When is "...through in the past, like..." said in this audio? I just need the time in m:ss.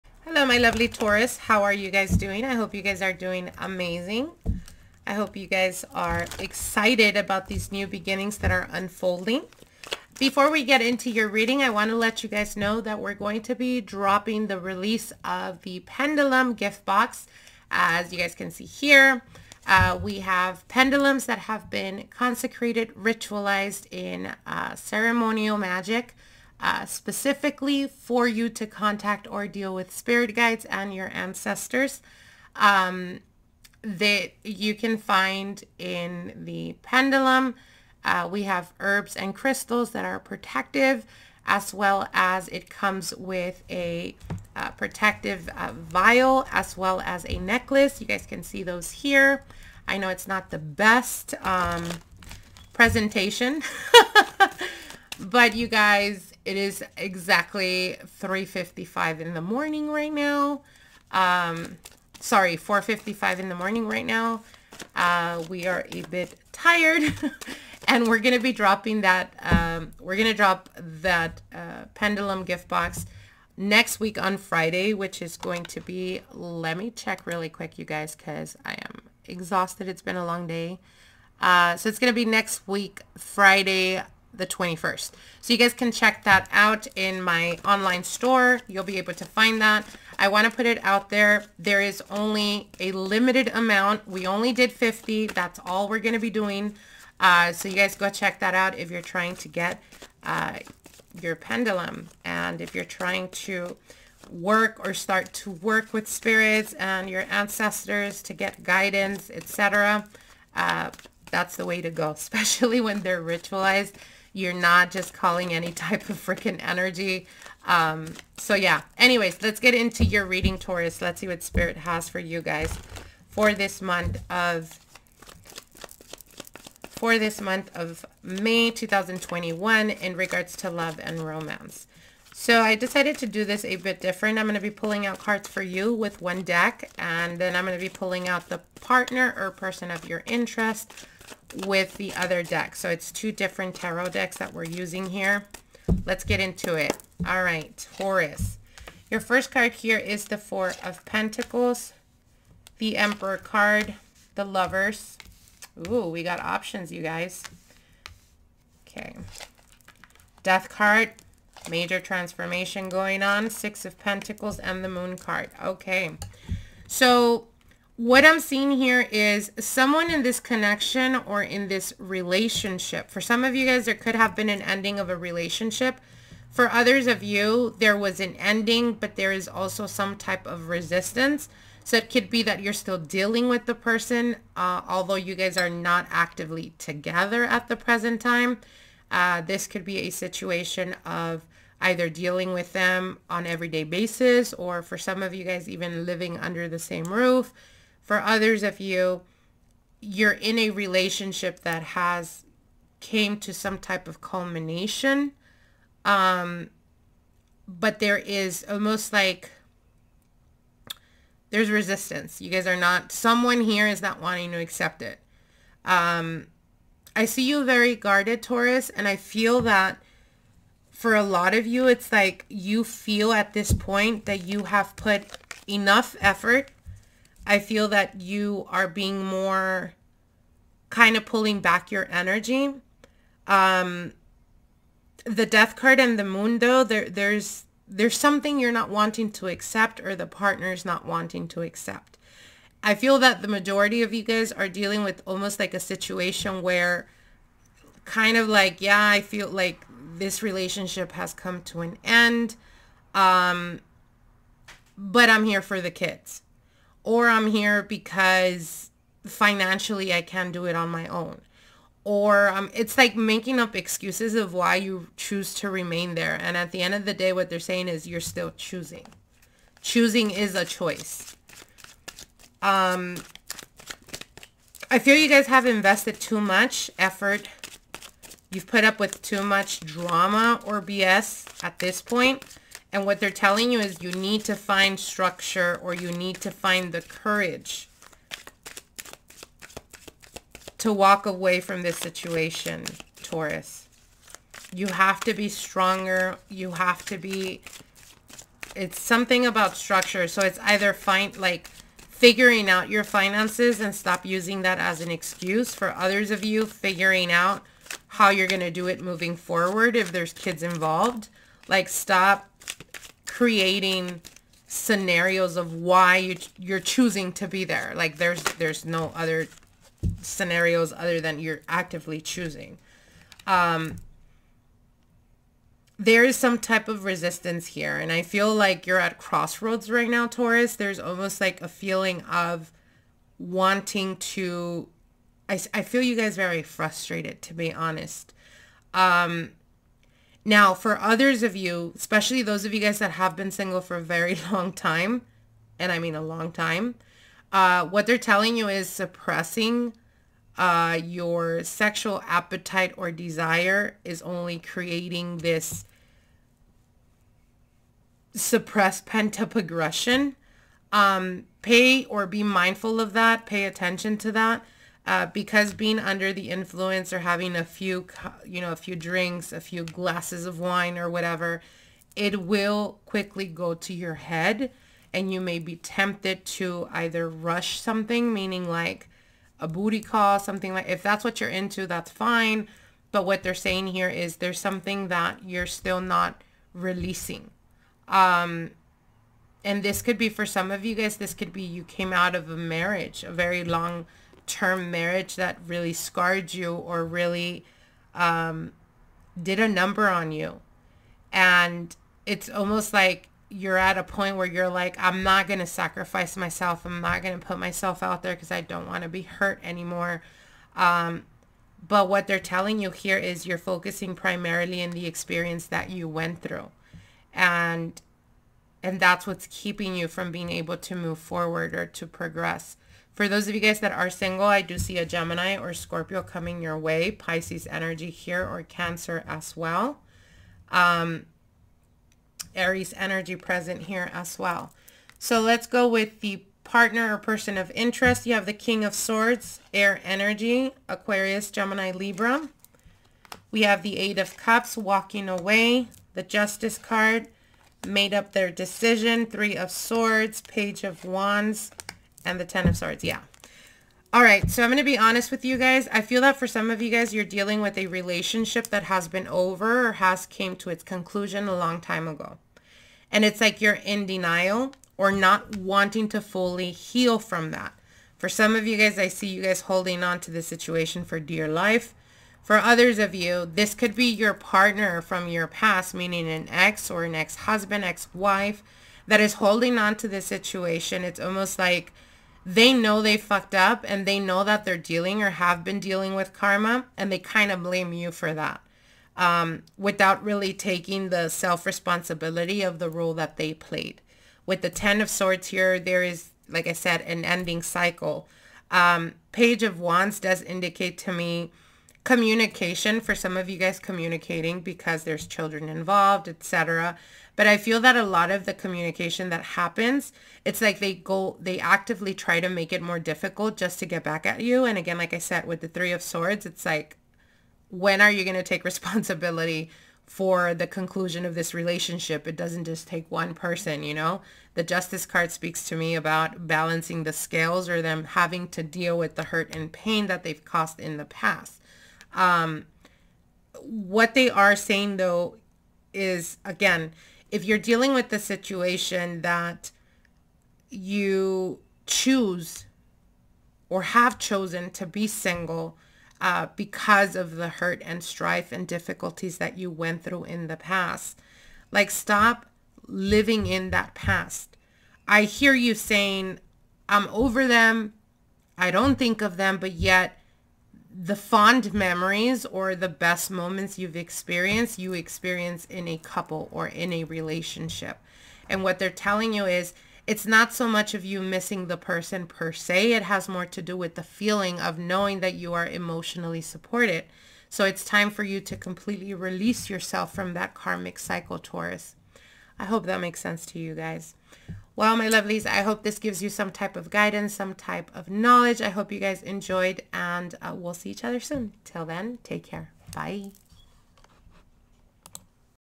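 9:10.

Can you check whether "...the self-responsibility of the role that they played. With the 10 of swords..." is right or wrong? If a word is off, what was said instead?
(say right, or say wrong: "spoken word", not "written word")
right.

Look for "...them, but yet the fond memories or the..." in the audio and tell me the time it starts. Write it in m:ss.
9:19.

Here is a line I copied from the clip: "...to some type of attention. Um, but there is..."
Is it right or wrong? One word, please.
wrong.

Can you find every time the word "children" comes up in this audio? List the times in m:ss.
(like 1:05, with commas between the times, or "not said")
8:25.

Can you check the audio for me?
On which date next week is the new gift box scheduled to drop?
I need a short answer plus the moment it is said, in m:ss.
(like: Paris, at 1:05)
Friday the 21st, at 1:23.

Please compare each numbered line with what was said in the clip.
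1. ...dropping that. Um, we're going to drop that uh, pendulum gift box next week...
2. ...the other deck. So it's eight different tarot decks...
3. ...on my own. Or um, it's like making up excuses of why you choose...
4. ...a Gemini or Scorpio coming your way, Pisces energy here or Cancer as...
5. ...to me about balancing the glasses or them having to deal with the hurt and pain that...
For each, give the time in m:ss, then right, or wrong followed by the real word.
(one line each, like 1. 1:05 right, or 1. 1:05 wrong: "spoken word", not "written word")
1. 1:08 right
2. 2:21 wrong: "two", not "eight"
3. 4:20 right
4. 7:04 right
5. 8:45 wrong: "scales", not "glasses".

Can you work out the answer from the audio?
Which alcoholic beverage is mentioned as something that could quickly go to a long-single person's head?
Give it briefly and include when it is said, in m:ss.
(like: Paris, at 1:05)
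Wine, at 6:10.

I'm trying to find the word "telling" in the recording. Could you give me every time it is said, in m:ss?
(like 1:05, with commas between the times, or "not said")
4:43, 5:48, 6:52, 9:28.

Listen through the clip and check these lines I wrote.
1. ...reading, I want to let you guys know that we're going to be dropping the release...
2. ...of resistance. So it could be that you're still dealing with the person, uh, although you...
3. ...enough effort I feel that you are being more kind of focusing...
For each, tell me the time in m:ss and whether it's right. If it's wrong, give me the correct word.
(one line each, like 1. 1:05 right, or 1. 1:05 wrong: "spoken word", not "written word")
1. 0:11 right
2. 3:00 right
3. 3:45 wrong: "pulling", not "focusing".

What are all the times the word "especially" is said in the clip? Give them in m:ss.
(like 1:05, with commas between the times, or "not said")
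1:52, 5:41.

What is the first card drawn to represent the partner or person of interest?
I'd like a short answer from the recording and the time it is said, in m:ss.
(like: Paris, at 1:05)
King of Swords, at 7:18.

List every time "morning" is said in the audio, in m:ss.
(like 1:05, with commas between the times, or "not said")
0:59, 1:03.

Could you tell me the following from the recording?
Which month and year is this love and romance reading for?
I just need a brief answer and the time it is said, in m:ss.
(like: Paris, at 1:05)
May 2021, at 2:08.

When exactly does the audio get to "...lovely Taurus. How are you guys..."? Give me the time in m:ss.
0:00.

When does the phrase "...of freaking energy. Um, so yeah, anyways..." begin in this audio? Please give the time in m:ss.
1:56.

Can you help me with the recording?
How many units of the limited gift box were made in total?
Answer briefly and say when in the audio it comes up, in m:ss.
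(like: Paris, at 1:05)
50, at 1:34.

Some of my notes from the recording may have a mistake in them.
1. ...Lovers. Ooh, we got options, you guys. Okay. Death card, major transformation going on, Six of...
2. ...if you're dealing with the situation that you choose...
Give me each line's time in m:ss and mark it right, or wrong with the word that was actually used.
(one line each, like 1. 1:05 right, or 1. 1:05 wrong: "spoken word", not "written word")
1. 2:34 right
2. 8:57 right.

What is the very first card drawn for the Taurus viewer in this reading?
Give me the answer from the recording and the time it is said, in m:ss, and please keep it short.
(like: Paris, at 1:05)
Four of Pentacles, at 2:30.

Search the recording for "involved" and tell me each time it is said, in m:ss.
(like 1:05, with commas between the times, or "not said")
5:10, 8:25.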